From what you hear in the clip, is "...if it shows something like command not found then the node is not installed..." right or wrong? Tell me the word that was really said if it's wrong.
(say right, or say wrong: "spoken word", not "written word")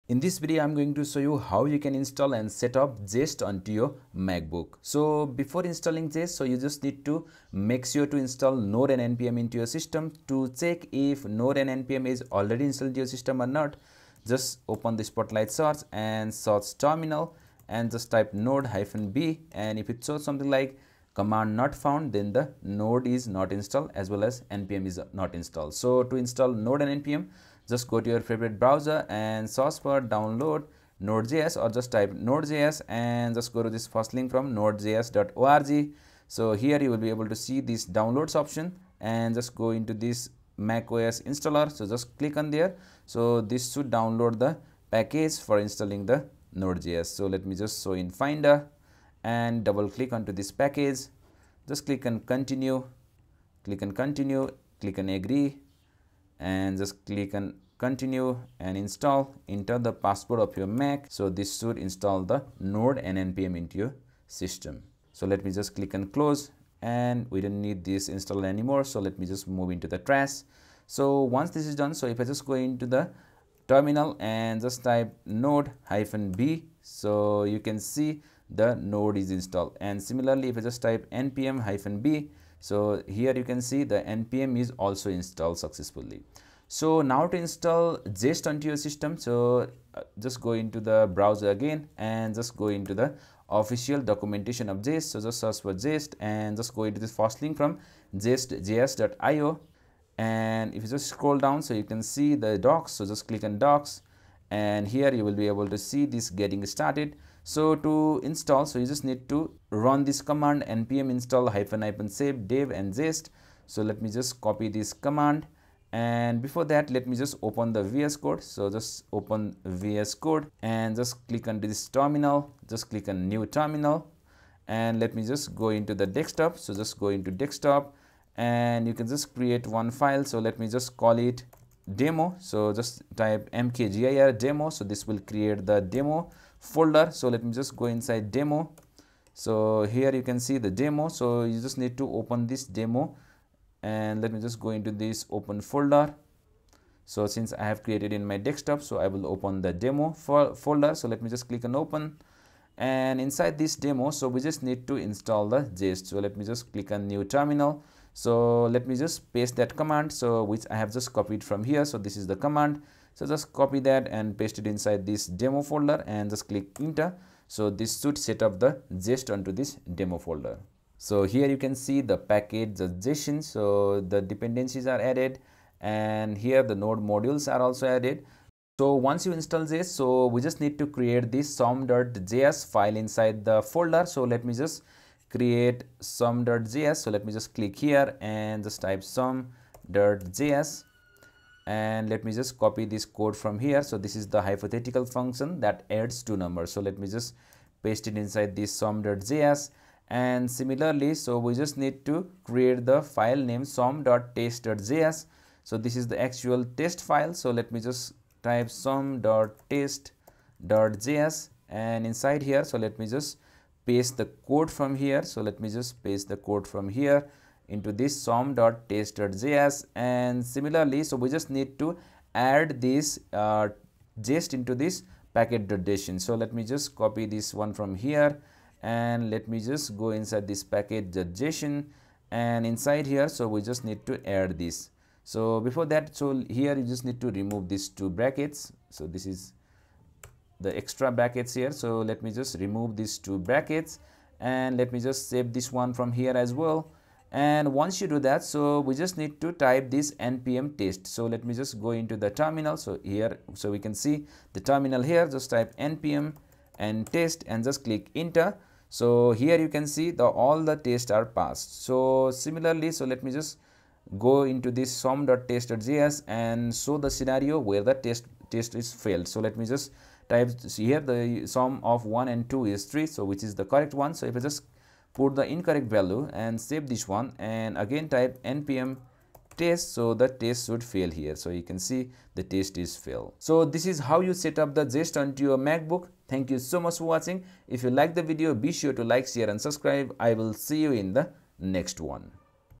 right.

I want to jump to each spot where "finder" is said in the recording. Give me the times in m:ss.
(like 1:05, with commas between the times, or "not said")
0:48.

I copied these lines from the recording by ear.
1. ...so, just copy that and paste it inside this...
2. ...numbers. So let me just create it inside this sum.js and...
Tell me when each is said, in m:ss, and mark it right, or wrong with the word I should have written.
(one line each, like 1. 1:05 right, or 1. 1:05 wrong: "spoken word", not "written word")
1. 2:43 right
2. 3:16 wrong: "paste", not "create".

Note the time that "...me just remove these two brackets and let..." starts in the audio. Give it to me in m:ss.
4:02.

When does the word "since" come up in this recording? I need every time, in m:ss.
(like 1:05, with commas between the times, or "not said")
2:27.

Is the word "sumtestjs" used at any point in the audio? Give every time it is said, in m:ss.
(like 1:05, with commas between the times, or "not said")
3:23, 3:28, 3:38, 4:24.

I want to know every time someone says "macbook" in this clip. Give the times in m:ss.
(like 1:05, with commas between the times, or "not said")
0:04, 4:45.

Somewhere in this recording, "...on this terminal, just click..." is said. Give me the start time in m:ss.
2:01.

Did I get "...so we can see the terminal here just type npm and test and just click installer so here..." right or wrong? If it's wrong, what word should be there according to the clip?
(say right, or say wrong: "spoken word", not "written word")
wrong: "enter", not "installer".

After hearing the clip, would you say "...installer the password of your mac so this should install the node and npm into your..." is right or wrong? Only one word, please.
wrong.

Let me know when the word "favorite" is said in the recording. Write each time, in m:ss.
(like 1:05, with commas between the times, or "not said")
0:28.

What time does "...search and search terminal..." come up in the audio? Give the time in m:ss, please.
0:15.